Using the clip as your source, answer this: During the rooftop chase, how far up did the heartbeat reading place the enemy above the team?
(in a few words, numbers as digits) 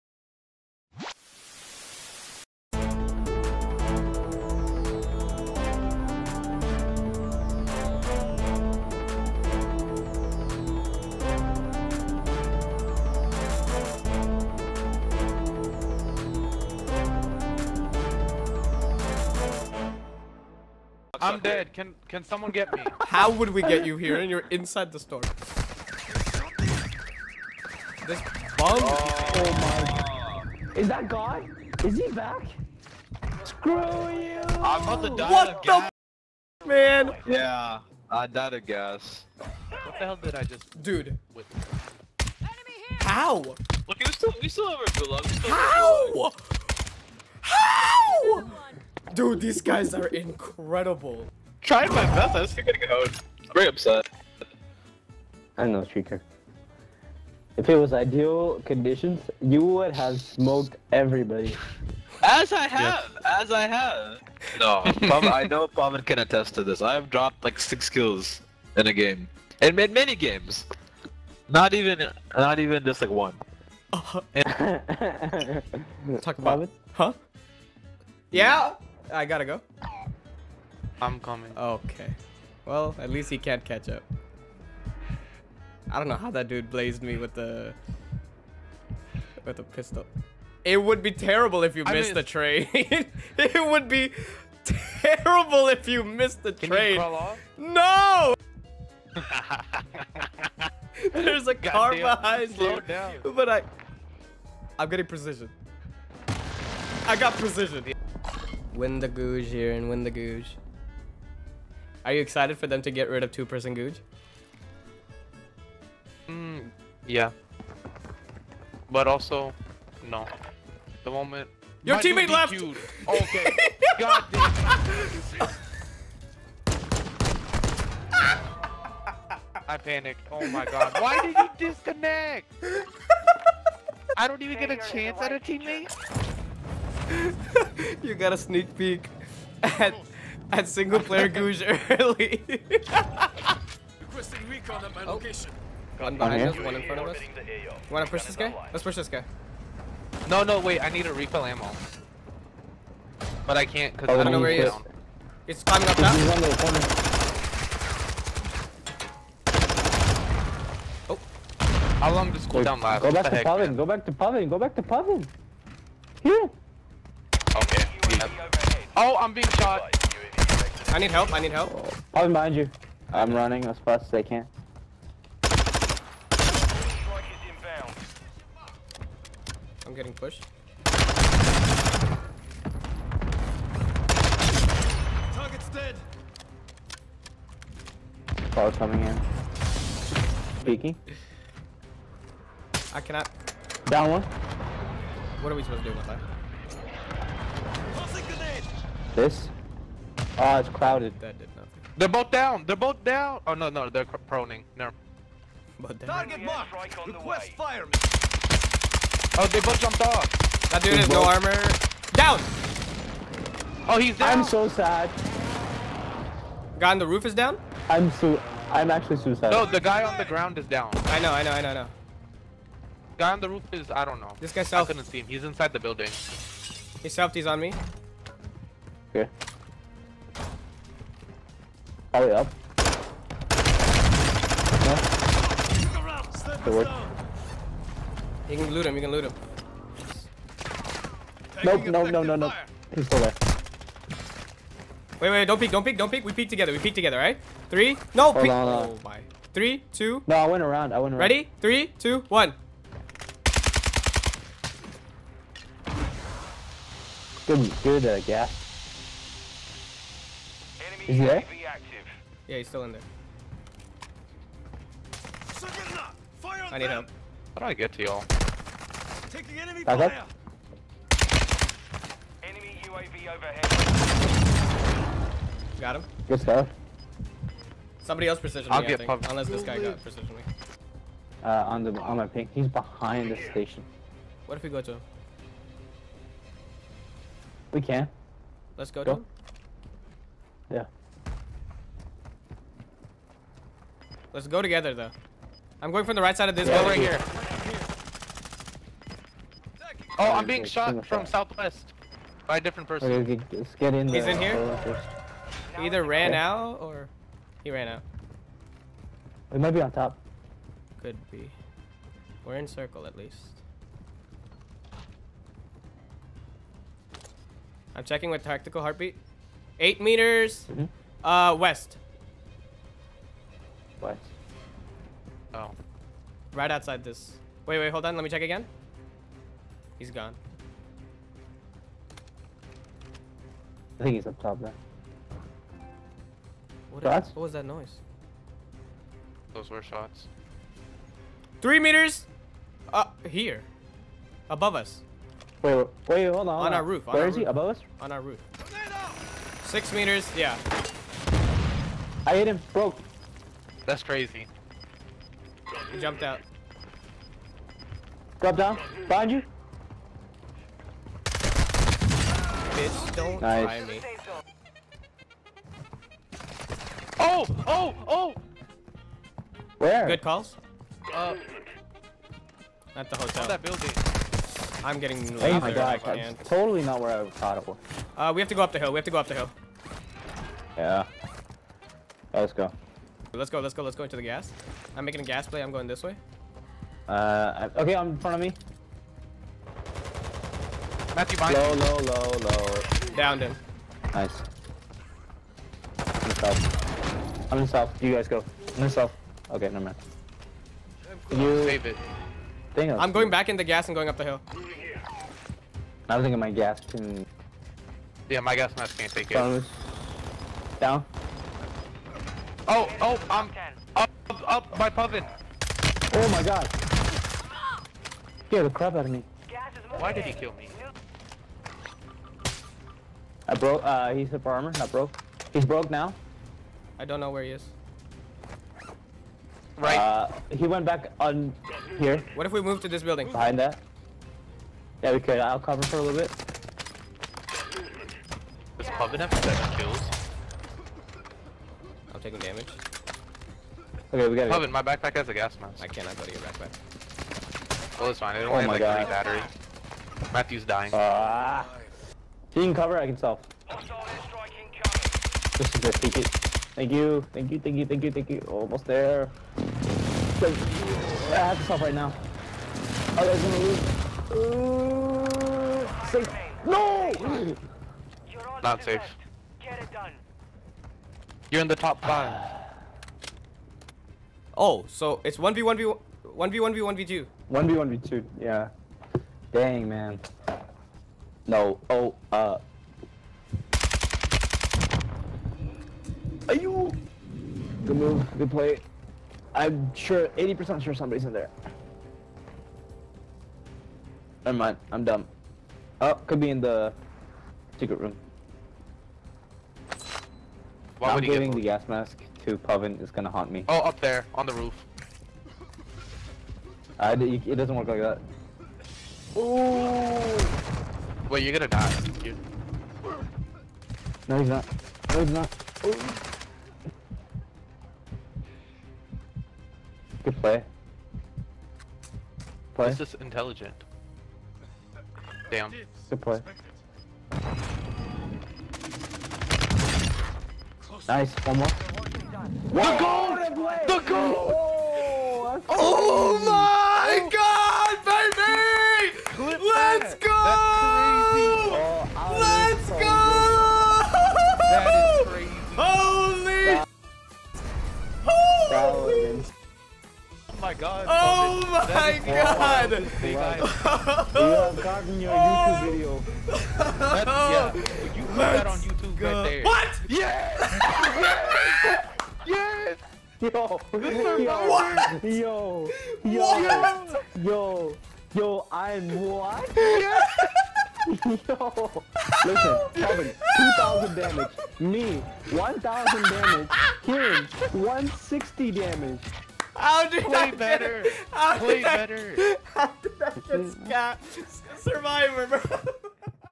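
6 meters.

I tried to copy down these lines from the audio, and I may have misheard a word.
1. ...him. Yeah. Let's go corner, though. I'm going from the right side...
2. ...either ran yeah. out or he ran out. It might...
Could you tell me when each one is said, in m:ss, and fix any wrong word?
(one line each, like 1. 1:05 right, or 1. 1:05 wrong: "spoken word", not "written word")
1. 4:49 wrong: "together", not "corner"
2. 5:05 right.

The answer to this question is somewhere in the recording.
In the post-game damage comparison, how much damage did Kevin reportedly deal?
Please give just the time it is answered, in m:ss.
9:33.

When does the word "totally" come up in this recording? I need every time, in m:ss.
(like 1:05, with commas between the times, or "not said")
6:16.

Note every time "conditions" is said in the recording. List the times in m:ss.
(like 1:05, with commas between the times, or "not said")
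0:58.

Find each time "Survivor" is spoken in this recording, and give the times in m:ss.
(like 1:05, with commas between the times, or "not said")
9:44.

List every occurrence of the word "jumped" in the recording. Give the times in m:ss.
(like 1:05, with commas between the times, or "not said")
3:29, 5:56.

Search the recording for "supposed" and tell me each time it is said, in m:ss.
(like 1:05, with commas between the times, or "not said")
3:15.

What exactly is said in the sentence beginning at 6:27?
Uh, okay, I'm in front of me.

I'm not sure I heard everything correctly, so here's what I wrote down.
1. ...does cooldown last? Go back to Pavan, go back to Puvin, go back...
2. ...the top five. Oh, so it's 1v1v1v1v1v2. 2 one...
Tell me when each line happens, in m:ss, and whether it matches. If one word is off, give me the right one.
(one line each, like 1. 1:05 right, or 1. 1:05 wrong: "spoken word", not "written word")
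1. 2:42 wrong: "Pavan", not "Puvin"
2. 7:51 right.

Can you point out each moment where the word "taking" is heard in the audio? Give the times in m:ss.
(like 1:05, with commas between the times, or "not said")
4:29, 7:22.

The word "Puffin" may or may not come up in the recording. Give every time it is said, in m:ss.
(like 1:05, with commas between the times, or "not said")
6:54, 7:18.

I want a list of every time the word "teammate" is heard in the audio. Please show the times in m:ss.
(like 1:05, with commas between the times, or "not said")
2:01, 2:15.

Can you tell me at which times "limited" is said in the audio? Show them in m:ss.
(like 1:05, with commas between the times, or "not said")
not said.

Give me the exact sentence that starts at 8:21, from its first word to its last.
Why I'm giving the gas mask to Puvin.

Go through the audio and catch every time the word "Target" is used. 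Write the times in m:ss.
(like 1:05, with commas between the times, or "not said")
3:05, 3:25.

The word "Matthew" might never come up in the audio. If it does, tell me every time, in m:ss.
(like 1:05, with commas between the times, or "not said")
6:31, 7:30.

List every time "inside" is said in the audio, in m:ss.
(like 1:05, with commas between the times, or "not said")
0:24, 3:45.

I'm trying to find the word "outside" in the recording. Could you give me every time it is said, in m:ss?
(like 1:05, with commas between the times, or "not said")
5:26.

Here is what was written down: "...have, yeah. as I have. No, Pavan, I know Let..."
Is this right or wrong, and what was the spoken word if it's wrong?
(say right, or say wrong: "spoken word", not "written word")
wrong: "Pavan", not "Let".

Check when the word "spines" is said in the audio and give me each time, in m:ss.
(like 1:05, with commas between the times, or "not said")
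not said.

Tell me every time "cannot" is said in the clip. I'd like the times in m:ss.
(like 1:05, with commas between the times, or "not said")
3:13, 7:25.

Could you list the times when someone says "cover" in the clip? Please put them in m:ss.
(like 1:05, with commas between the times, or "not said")
7:15, 7:32.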